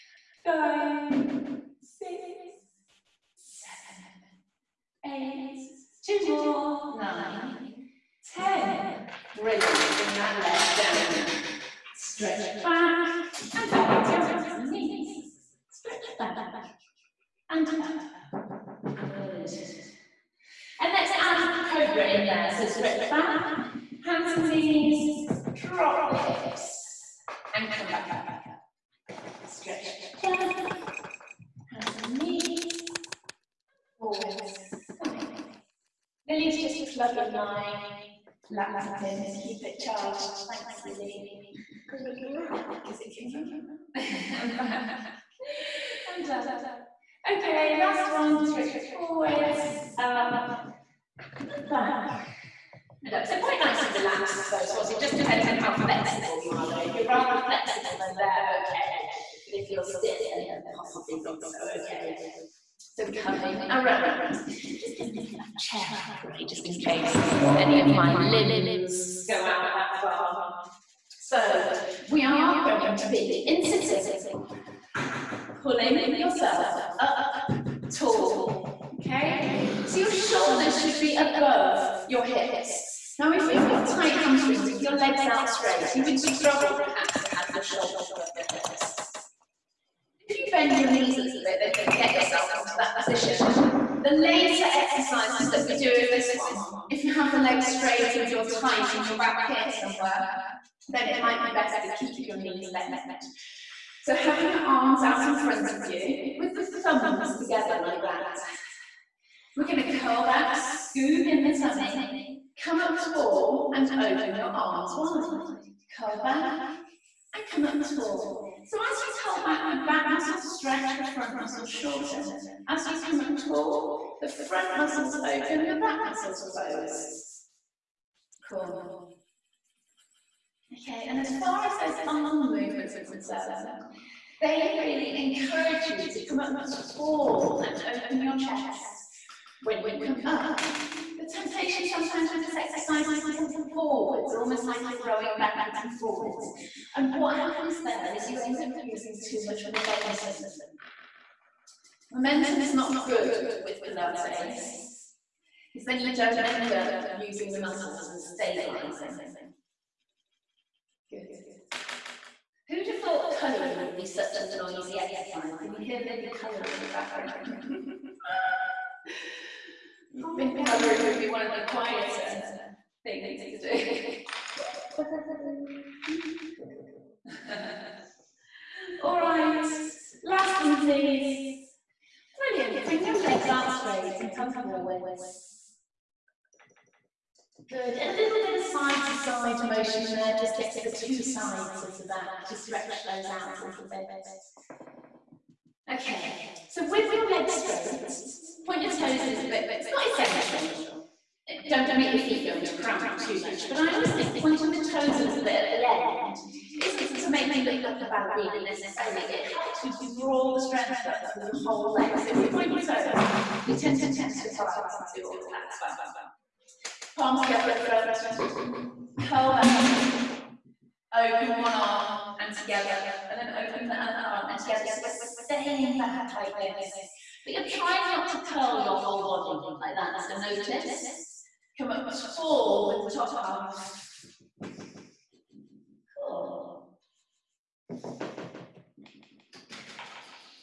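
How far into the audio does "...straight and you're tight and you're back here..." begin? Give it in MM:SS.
01:37.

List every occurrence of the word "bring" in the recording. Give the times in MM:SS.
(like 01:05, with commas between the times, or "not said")
00:09, 03:02.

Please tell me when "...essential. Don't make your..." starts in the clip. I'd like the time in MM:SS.
03:20.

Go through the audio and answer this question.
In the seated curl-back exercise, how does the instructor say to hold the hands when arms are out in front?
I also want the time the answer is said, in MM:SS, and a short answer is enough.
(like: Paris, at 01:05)
Thumbs together, at 01:46.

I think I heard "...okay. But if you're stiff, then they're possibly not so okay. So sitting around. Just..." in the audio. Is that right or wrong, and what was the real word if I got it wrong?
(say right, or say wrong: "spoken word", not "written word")
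wrong: "coming", not "sitting".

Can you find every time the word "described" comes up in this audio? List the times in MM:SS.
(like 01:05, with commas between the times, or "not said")
not said.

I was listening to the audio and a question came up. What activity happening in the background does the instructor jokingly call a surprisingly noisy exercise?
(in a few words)
Colouring.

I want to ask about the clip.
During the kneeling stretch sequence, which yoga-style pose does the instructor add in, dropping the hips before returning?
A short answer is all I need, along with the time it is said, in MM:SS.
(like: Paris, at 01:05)
Cobra, at 00:21.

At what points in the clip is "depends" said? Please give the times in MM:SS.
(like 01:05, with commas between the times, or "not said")
00:55.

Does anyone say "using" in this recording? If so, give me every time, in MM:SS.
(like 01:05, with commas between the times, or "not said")
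02:28, 02:37.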